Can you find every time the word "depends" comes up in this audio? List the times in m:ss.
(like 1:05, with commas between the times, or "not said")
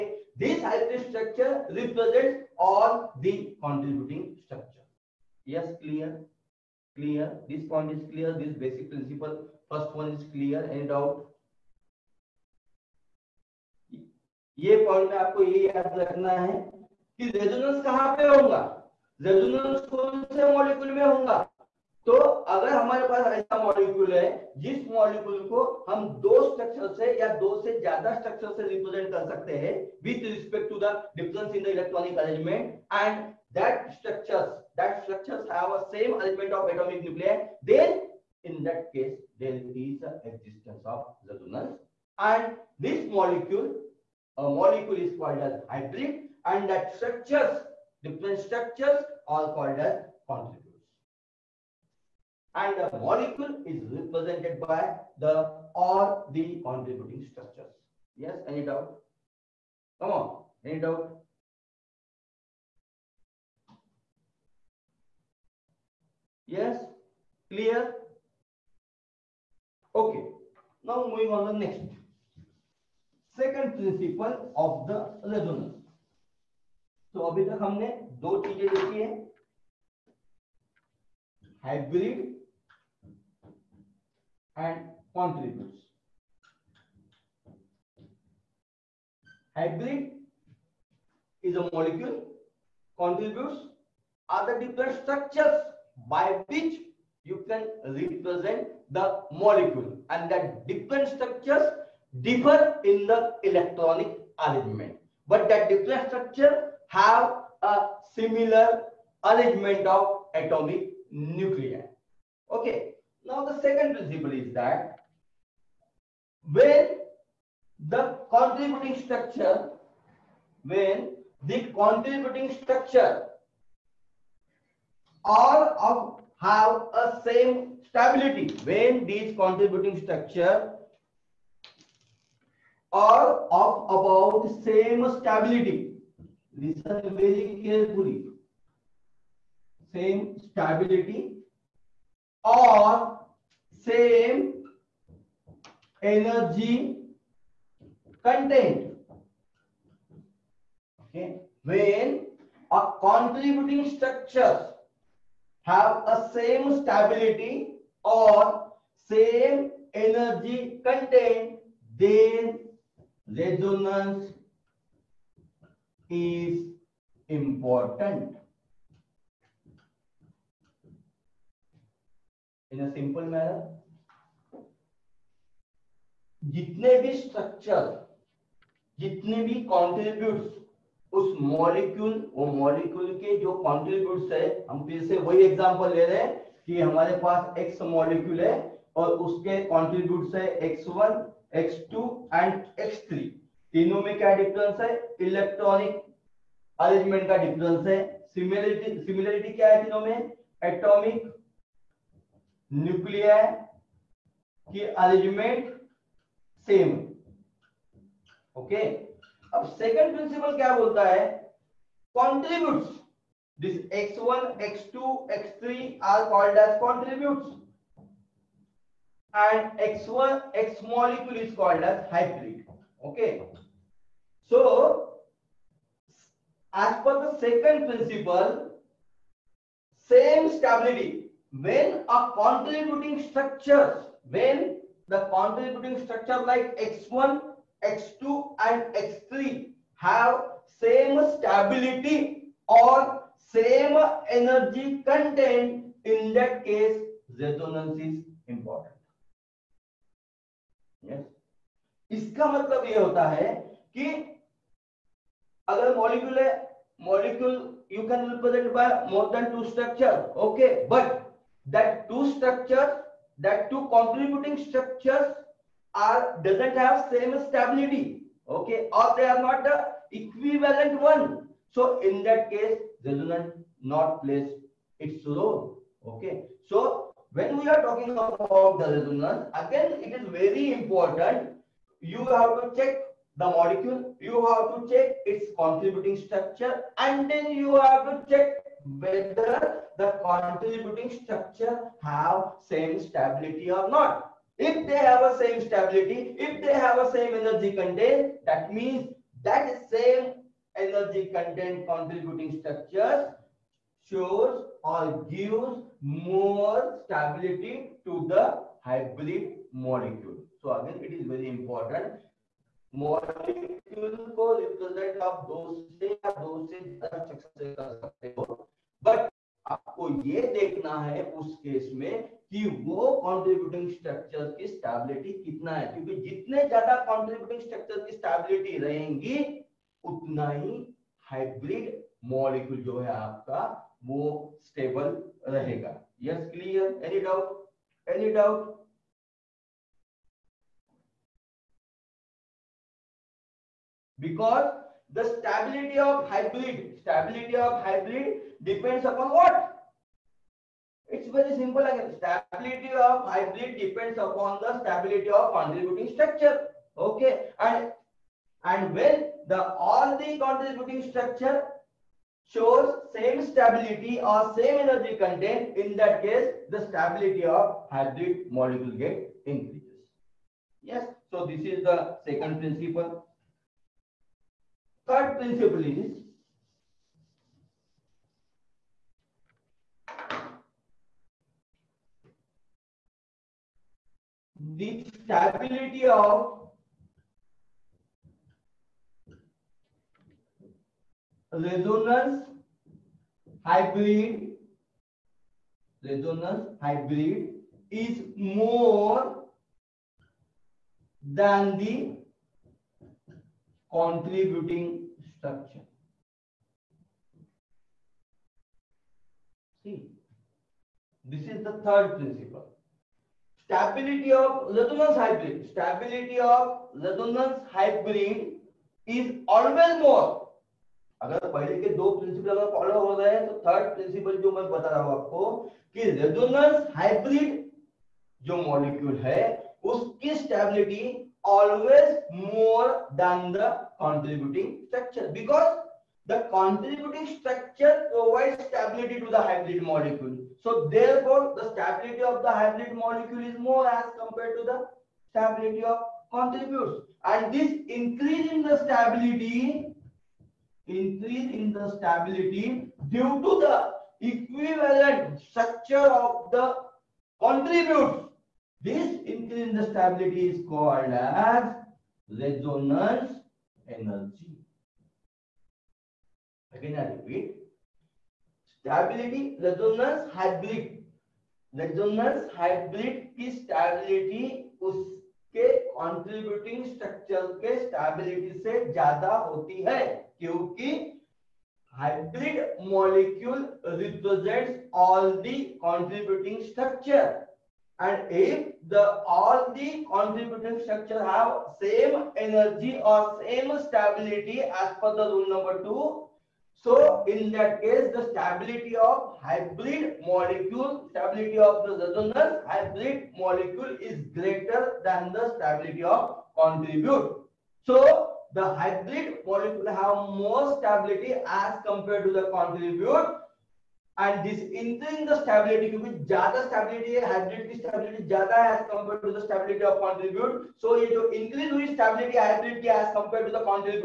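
5:48, 5:53.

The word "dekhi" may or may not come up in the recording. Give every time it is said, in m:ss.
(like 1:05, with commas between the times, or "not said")
1:18.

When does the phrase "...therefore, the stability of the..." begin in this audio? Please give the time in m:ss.
7:20.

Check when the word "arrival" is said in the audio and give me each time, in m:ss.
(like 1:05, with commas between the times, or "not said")
not said.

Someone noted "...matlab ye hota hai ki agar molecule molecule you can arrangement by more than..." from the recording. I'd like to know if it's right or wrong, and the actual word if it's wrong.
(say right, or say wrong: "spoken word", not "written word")
wrong: "represent", not "arrangement".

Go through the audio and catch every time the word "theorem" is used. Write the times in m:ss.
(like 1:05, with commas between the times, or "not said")
not said.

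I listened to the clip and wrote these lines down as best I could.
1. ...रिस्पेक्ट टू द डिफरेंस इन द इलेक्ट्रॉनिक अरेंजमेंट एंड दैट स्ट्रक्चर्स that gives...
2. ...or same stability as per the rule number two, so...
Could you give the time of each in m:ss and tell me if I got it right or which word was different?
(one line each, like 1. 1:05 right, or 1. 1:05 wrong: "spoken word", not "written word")
1. 0:30 wrong: "structures", not "gives"
2. 8:13 right.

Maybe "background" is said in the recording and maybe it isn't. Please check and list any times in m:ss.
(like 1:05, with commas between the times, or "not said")
not said.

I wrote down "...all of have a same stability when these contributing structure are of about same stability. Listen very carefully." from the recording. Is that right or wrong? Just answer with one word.
right.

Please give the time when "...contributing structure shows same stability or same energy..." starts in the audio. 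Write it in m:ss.
6:00.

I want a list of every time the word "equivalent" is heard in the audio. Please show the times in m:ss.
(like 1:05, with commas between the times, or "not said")
4:30, 7:34.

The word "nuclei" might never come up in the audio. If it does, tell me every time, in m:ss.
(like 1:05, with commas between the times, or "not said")
0:37, 1:51.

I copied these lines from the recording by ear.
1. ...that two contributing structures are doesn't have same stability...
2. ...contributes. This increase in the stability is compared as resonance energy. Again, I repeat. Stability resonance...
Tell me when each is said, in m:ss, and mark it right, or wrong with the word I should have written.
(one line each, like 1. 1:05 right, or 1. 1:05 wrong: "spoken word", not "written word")
1. 4:23 right
2. 7:37 wrong: "called", not "compared".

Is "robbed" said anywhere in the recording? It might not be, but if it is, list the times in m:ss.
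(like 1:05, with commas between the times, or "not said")
not said.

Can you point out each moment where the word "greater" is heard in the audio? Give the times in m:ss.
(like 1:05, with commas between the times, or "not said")
8:24.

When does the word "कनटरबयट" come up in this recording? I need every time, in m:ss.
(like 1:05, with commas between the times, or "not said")
1:25, 3:03, 3:09, 3:32, 3:36.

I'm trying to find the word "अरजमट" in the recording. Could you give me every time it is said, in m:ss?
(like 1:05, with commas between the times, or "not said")
0:32, 3:16, 3:25.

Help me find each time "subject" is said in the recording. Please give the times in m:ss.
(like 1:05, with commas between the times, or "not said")
not said.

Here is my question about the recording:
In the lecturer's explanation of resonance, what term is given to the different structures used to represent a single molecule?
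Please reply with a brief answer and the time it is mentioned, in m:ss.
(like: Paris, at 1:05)
contributors, at 0:50.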